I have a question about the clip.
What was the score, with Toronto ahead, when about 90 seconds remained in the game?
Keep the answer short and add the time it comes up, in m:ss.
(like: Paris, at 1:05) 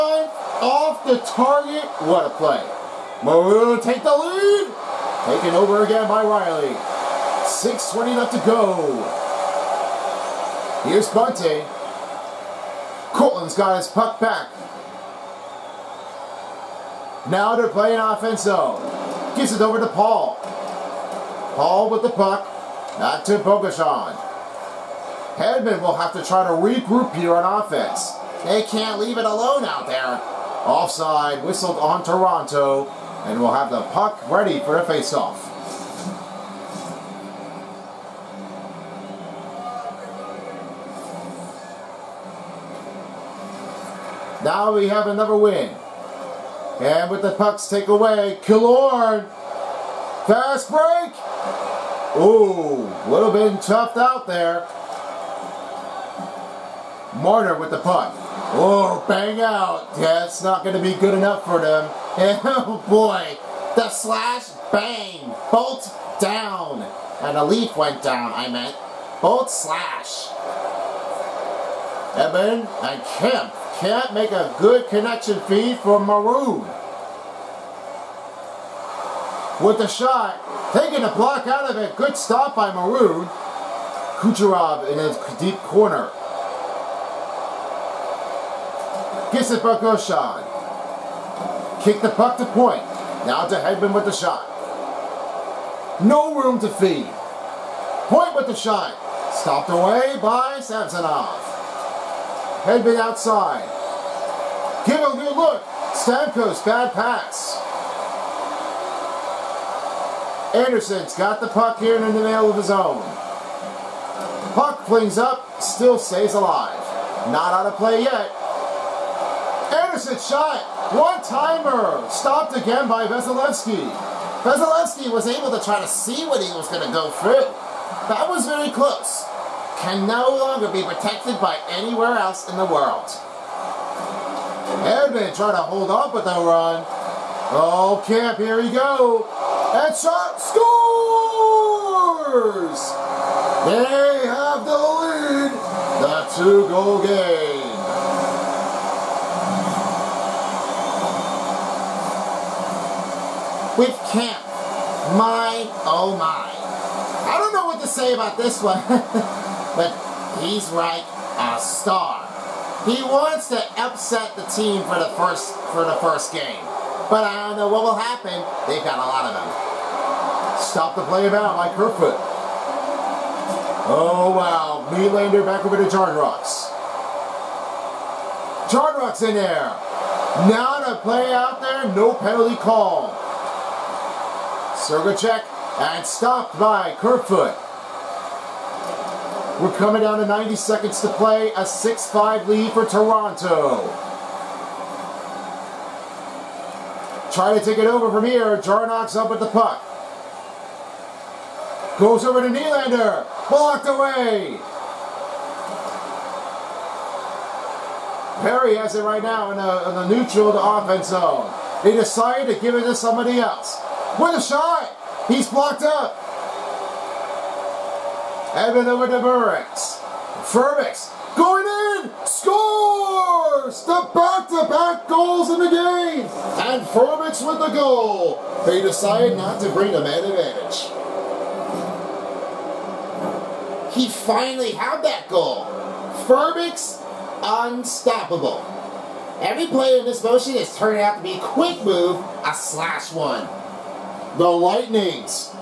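6-5, at 3:11.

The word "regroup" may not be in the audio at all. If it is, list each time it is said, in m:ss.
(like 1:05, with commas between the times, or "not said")
0:26.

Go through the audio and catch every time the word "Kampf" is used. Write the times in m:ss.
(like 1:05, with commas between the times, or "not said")
2:18, 2:34.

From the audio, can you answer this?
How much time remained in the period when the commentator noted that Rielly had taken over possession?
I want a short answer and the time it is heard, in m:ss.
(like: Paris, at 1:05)
6:20, at 0:07.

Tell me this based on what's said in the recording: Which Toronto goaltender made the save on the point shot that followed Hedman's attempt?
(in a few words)
Samsonov.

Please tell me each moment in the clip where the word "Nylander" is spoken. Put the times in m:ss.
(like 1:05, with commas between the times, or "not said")
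2:54, 3:22.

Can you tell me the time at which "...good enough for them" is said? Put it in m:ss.
1:00.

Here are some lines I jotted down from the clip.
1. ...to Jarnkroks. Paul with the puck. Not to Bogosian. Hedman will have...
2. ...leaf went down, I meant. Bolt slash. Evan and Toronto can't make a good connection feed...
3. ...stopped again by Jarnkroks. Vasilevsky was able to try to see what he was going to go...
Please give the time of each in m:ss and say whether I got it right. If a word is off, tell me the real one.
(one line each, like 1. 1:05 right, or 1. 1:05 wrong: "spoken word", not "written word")
1. 0:19 wrong: "Paul", not "Jarnkroks"
2. 1:07 wrong: "Kemp", not "Toronto"
3. 2:02 wrong: "Vasilevsky", not "Jarnkroks".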